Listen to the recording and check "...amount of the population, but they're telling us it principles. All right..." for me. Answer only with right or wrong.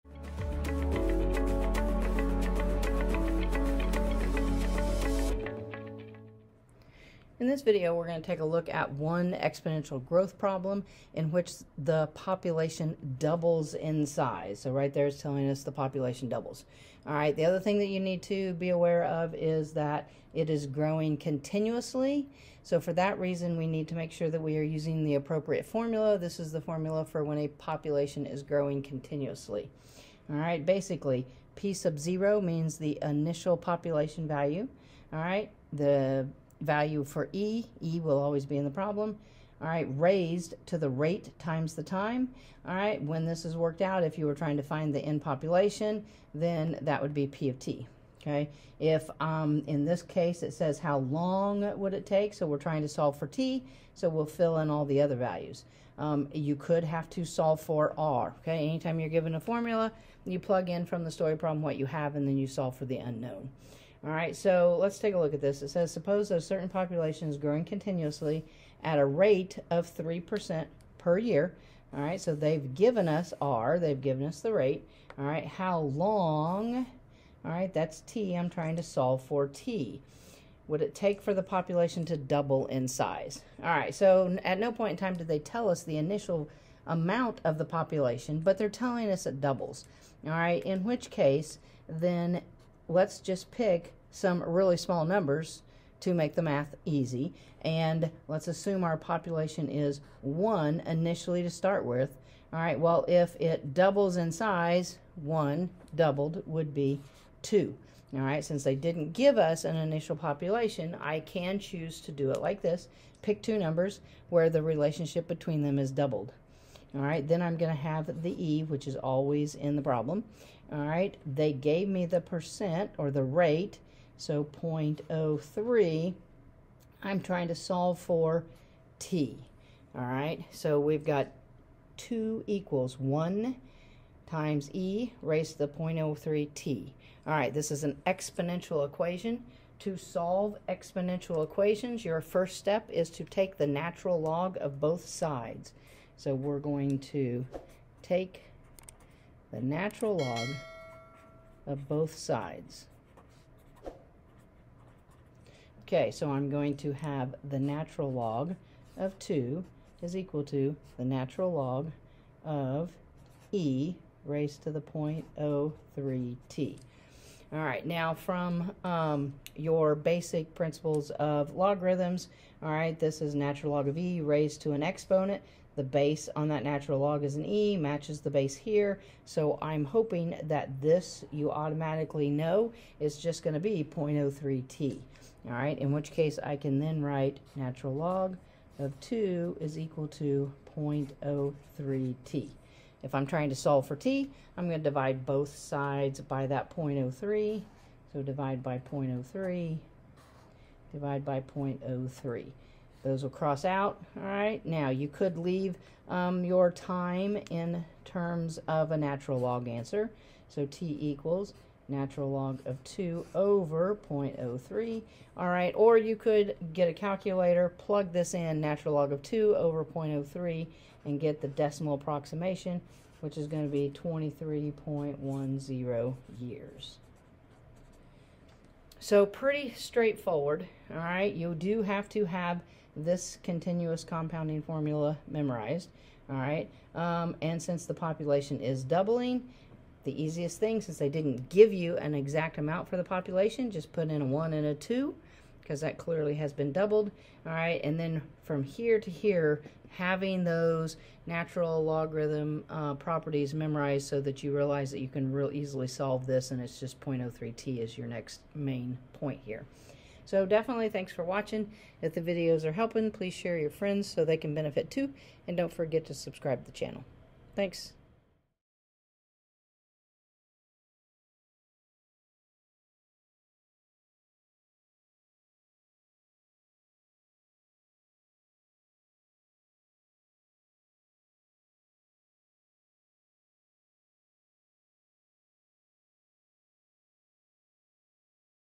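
wrong.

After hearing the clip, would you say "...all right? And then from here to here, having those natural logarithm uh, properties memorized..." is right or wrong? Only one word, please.
right.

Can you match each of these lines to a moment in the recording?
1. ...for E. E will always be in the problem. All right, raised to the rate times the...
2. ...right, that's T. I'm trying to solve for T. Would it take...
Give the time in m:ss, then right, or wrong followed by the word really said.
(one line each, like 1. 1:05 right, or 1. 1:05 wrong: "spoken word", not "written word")
1. 0:37 right
2. 1:17 right.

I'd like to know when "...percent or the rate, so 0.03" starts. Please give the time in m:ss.
2:02.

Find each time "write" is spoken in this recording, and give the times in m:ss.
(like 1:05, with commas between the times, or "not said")
3:07.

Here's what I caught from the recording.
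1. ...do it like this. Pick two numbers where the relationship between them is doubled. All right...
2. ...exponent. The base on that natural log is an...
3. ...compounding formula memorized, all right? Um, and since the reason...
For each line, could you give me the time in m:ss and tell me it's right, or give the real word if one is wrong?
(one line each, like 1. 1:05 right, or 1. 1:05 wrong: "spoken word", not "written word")
1. 1:52 right
2. 2:54 right
3. 3:54 wrong: "population", not "reason".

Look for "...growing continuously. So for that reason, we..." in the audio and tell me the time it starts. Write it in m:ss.
0:20.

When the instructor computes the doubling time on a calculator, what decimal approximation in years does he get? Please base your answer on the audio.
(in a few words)
23.10 years.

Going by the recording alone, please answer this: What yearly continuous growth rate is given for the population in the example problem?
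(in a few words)
3%.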